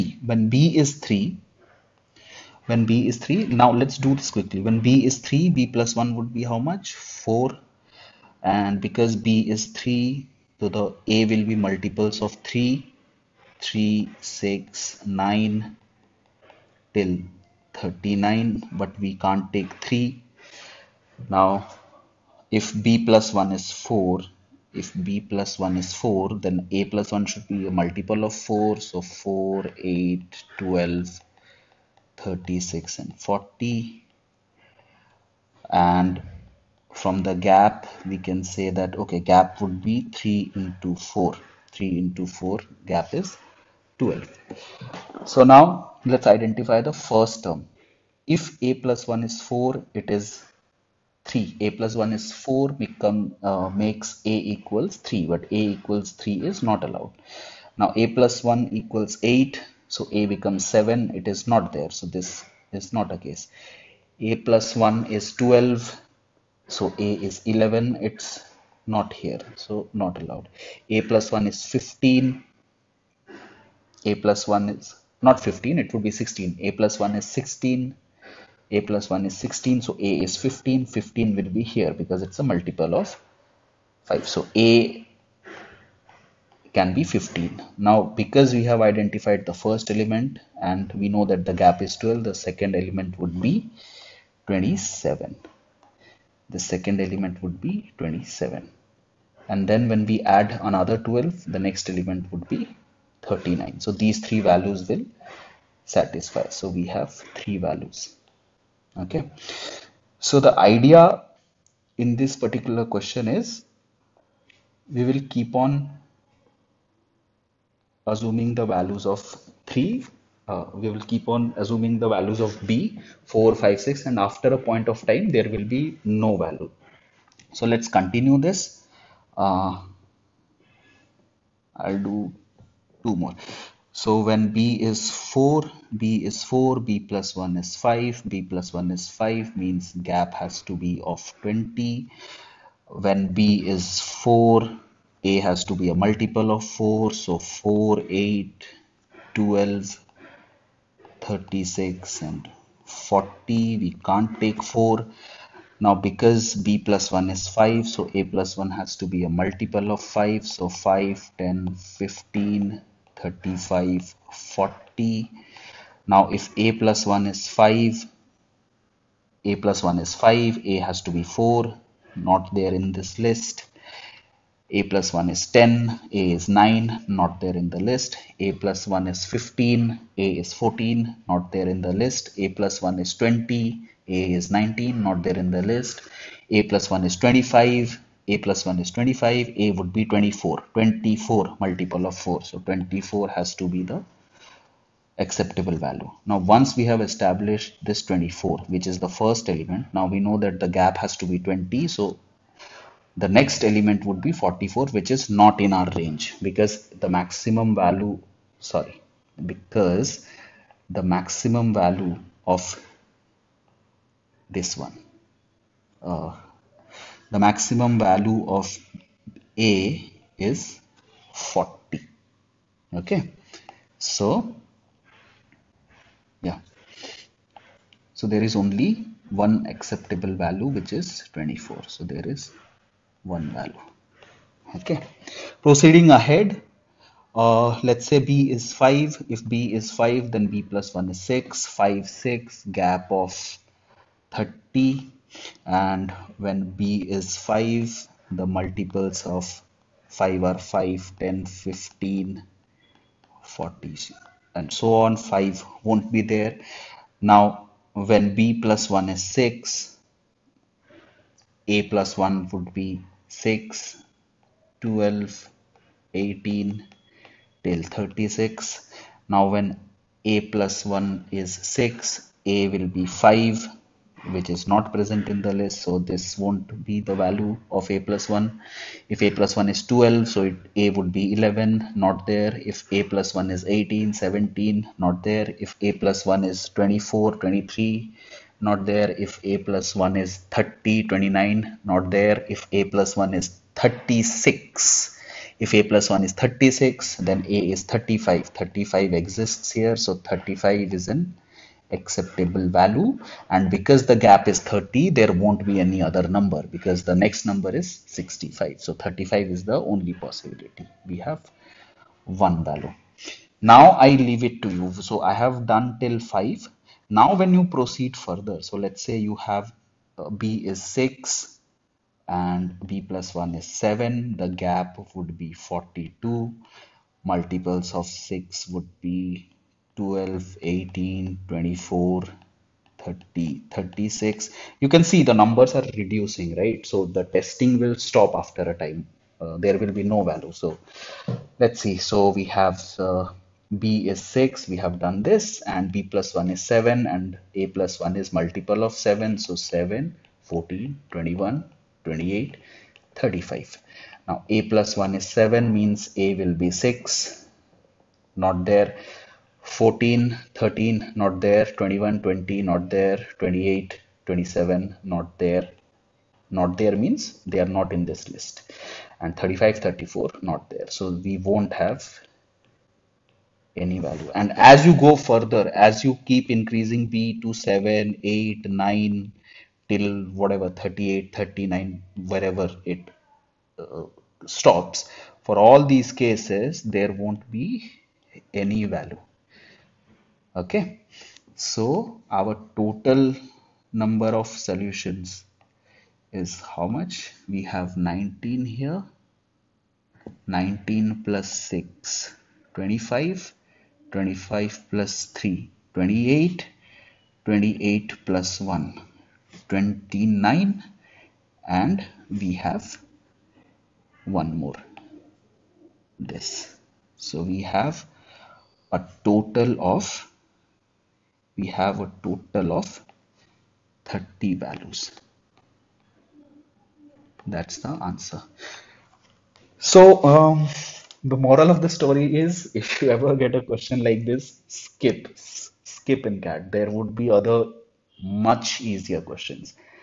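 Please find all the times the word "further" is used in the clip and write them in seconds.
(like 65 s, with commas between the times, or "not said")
318 s, 375 s.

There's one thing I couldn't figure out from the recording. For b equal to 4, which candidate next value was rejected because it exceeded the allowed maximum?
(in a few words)
44.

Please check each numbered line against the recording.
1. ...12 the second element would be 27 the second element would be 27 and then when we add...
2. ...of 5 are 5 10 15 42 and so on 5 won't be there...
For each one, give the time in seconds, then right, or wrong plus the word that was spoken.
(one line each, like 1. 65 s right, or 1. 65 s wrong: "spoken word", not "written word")
1. 92 s right
2. 249 s wrong: "40", not "42".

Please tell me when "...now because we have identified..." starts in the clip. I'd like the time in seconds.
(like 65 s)
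87 s.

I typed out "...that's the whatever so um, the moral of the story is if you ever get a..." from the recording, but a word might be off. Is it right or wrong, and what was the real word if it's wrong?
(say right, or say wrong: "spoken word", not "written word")
wrong: "answer", not "whatever".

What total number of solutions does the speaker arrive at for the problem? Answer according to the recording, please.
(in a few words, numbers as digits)
30.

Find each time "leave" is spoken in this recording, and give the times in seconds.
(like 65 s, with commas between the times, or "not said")
314 s.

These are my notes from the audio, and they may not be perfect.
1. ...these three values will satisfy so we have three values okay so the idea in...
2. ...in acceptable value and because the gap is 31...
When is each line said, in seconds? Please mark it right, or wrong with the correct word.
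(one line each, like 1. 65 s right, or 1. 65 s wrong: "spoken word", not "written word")
1. 104 s right
2. 301 s wrong: "30", not "31".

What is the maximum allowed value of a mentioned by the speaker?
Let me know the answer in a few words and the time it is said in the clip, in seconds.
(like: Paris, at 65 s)
40, at 217 s.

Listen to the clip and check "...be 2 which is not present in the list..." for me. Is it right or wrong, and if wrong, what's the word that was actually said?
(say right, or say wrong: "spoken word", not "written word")
wrong: "5", not "2".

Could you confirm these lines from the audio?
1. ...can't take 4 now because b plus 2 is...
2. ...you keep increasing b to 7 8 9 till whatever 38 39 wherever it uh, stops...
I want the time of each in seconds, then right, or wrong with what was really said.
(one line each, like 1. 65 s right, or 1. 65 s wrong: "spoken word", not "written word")
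1. 154 s wrong: "1", not "2"
2. 376 s right.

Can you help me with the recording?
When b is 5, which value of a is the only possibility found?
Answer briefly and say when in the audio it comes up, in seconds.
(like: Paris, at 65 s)
35, at 308 s.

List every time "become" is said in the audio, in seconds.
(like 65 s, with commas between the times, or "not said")
52 s, 60 s.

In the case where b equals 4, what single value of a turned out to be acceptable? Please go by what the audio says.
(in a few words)
24.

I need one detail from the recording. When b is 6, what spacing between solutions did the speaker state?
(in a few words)
42.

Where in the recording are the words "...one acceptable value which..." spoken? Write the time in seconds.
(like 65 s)
229 s.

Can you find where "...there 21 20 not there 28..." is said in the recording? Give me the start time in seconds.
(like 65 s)
361 s.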